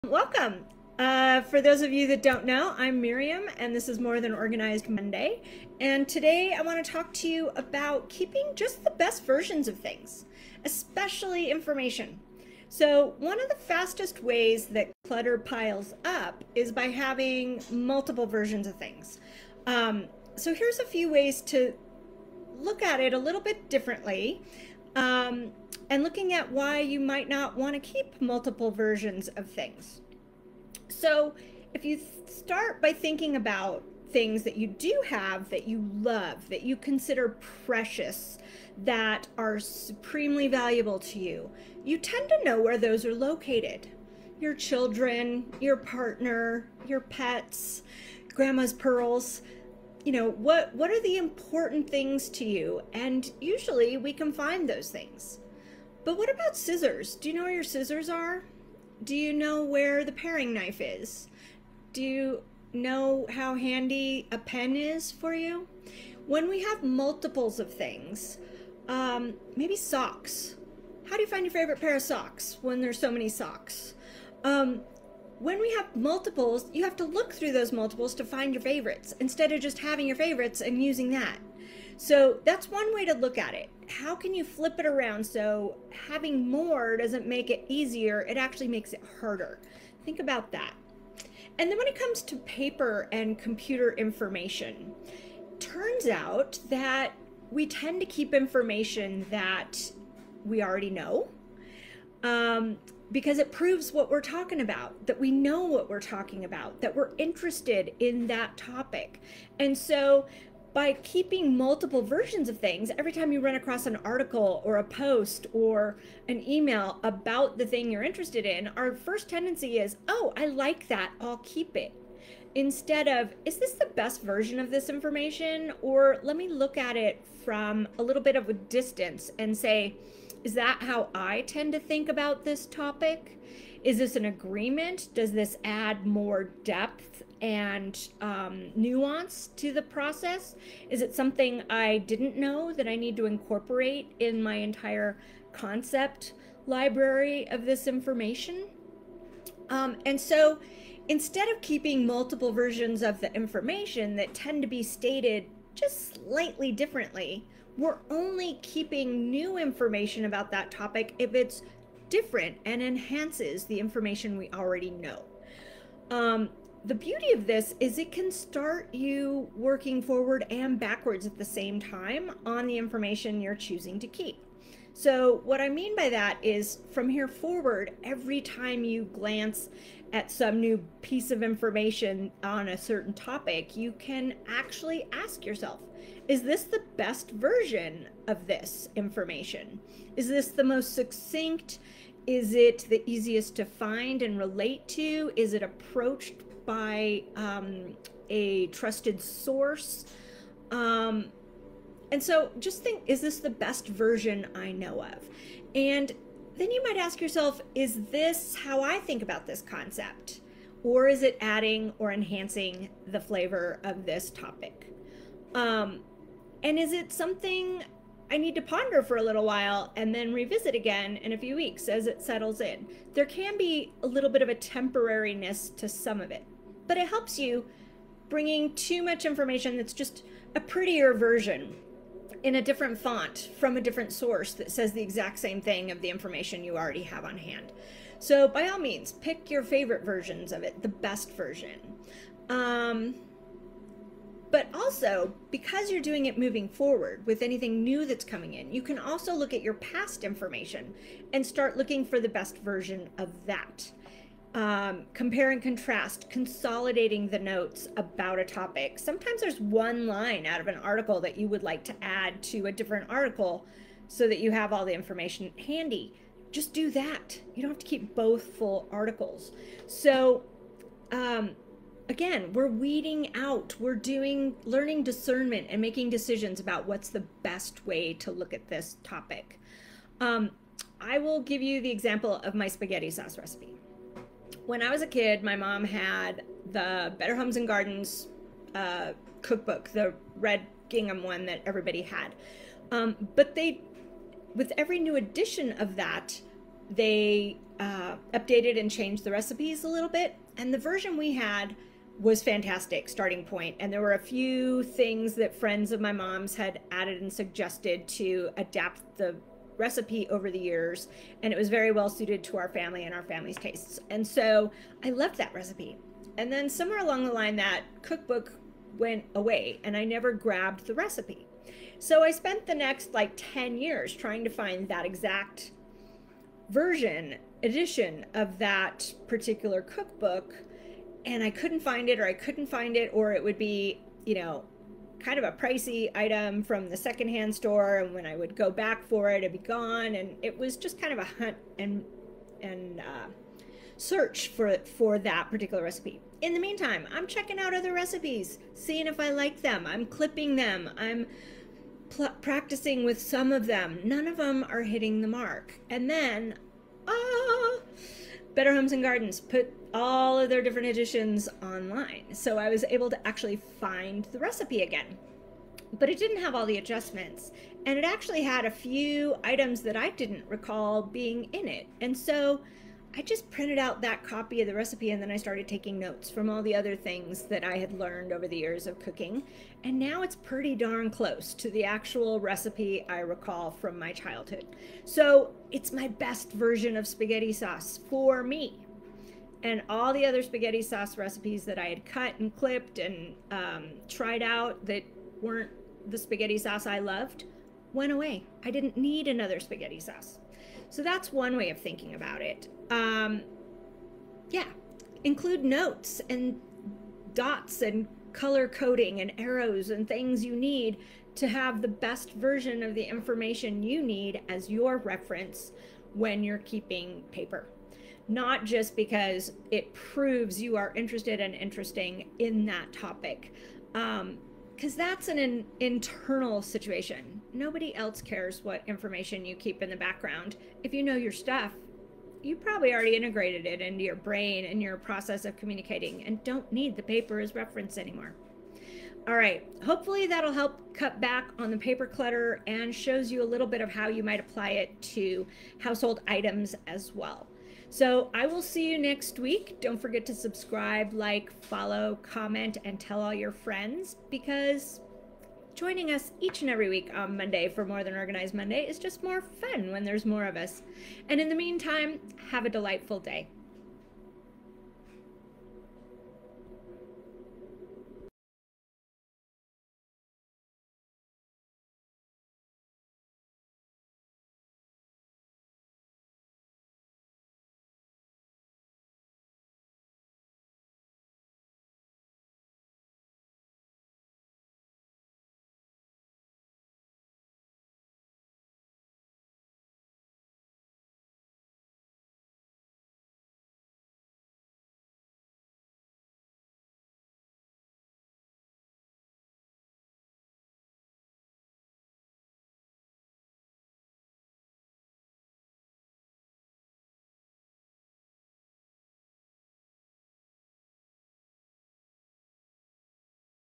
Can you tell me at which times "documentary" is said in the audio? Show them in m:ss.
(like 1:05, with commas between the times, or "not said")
not said.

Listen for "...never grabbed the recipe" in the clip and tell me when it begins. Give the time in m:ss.
5:20.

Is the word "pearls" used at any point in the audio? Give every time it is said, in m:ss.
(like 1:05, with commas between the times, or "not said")
0:48.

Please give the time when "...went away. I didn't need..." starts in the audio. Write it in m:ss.
6:37.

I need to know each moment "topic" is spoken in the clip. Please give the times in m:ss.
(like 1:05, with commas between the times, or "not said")
1:48, 2:12, 2:40, 3:03, 3:34, 4:18, 4:39, 7:02.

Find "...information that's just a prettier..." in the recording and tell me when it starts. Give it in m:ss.
3:49.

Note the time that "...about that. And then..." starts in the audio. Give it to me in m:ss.
1:30.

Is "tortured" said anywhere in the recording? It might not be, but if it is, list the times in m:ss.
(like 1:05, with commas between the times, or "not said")
not said.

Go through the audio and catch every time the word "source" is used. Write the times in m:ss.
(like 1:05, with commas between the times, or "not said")
3:19, 3:54.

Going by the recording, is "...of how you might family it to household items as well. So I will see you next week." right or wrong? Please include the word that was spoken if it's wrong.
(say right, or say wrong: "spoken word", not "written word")
wrong: "apply", not "family".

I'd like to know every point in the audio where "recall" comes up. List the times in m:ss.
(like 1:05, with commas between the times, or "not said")
6:10, 6:23.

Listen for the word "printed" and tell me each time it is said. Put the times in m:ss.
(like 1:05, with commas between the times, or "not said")
6:13.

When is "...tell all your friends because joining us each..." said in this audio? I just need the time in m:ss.
7:32.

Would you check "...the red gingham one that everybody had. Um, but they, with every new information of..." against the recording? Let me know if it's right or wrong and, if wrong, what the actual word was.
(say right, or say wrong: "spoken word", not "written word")
wrong: "edition", not "information".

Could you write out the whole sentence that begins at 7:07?
Nobody else cares what information you keep in the background.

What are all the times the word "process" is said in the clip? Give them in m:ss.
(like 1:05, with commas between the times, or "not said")
2:19, 7:14.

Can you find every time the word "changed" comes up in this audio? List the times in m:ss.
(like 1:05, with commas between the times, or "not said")
4:58.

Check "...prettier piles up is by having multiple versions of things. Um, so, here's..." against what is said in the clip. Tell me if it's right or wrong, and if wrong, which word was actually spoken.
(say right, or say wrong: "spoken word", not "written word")
wrong: "clutter", not "prettier".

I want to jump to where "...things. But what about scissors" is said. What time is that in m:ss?
0:54.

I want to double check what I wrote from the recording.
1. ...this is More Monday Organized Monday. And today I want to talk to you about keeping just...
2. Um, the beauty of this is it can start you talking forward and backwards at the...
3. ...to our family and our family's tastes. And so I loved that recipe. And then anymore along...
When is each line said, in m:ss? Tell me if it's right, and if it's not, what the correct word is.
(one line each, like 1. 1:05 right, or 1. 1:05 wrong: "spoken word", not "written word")
1. 0:03 wrong: "Than", not "Monday"
2. 2:46 wrong: "working", not "talking"
3. 5:12 wrong: "somewhere", not "anymore".